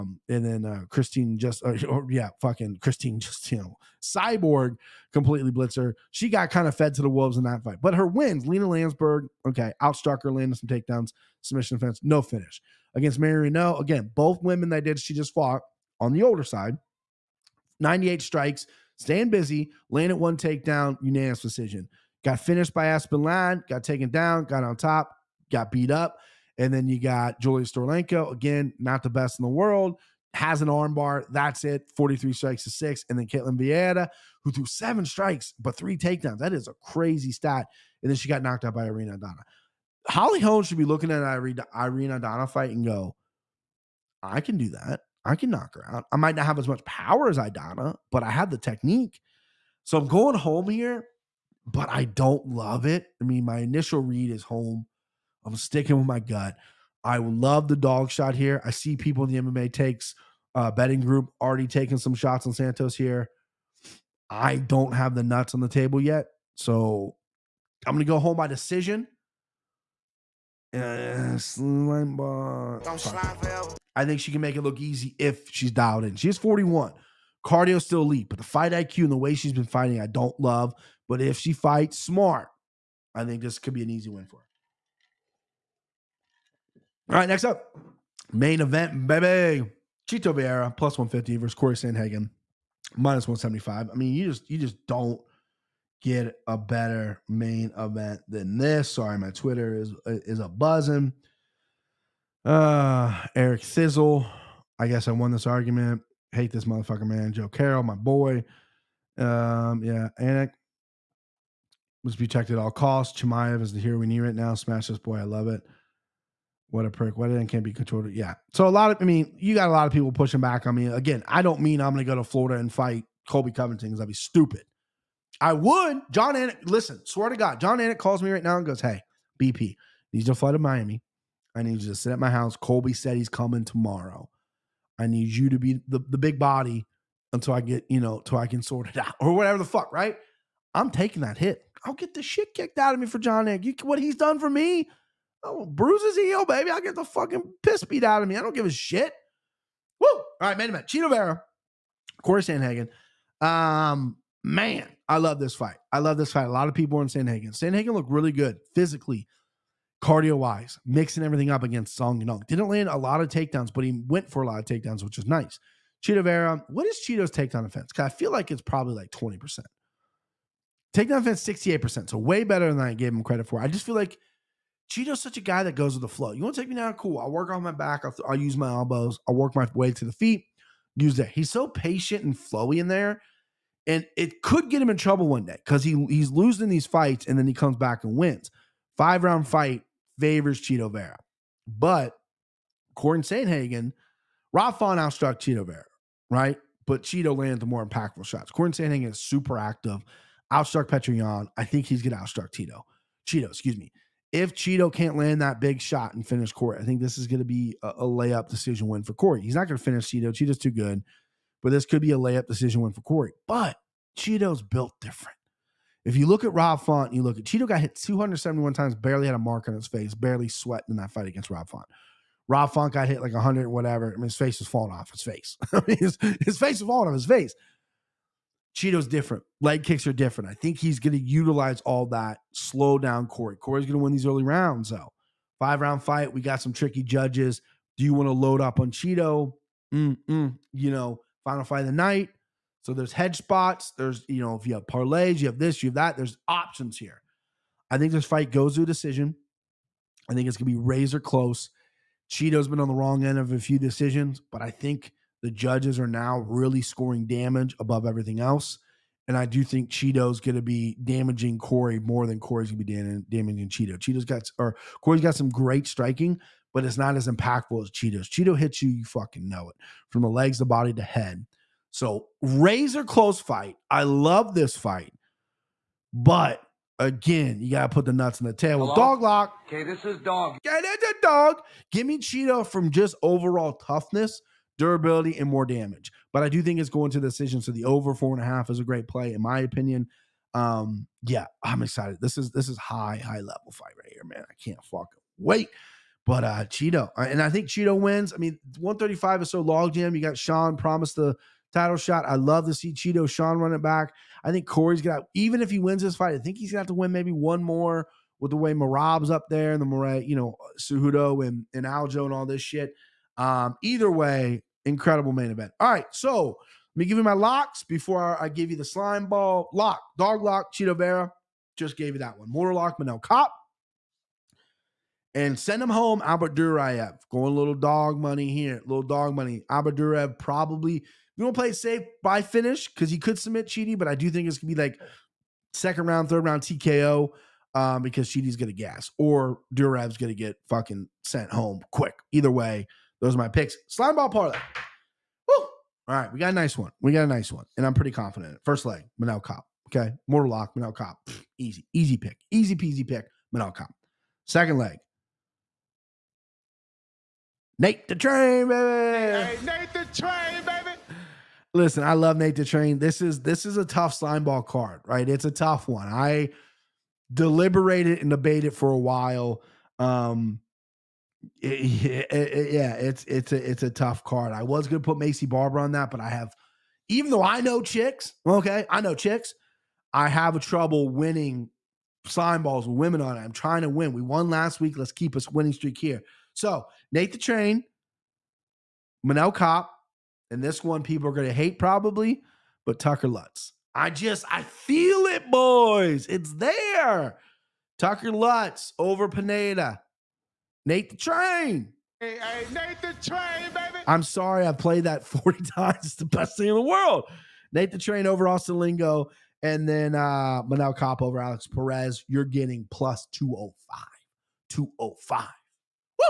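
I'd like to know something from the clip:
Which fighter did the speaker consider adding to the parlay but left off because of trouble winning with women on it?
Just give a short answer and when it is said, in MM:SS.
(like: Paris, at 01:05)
Maycee Barber, at 06:15.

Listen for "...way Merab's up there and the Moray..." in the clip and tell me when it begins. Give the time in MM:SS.
05:08.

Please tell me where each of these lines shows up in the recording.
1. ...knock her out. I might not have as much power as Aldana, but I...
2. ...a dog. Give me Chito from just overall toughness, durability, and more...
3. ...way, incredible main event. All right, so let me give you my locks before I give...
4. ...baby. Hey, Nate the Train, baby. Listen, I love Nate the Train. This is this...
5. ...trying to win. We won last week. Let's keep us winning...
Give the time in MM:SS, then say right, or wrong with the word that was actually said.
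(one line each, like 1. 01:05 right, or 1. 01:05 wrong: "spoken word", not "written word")
1. 00:45 right
2. 04:41 right
3. 05:14 right
4. 05:58 right
5. 06:23 right.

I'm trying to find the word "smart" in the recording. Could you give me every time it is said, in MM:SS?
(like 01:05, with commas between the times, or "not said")
01:21.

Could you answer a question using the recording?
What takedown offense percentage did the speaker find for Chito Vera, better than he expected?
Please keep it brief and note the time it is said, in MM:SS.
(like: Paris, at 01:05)
68%, at 02:51.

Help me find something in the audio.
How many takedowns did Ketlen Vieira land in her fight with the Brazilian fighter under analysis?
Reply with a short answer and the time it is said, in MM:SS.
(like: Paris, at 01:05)
3, at 00:35.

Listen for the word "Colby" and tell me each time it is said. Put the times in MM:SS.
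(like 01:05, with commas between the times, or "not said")
02:03, 02:12.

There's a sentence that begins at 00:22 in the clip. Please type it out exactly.
Got finished by Aspen Ladd, got taken down, got on top, got beat up.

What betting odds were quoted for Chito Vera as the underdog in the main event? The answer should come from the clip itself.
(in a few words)
+150.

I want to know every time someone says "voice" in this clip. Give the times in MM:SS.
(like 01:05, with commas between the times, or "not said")
not said.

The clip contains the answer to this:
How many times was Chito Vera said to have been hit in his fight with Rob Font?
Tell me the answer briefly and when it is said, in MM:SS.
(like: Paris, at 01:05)
271, at 03:37.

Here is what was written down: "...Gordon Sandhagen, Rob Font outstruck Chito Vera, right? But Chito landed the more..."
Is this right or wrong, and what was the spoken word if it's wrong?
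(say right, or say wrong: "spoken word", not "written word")
right.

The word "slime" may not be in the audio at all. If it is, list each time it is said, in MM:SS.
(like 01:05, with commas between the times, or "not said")
05:18, 05:43, 06:22.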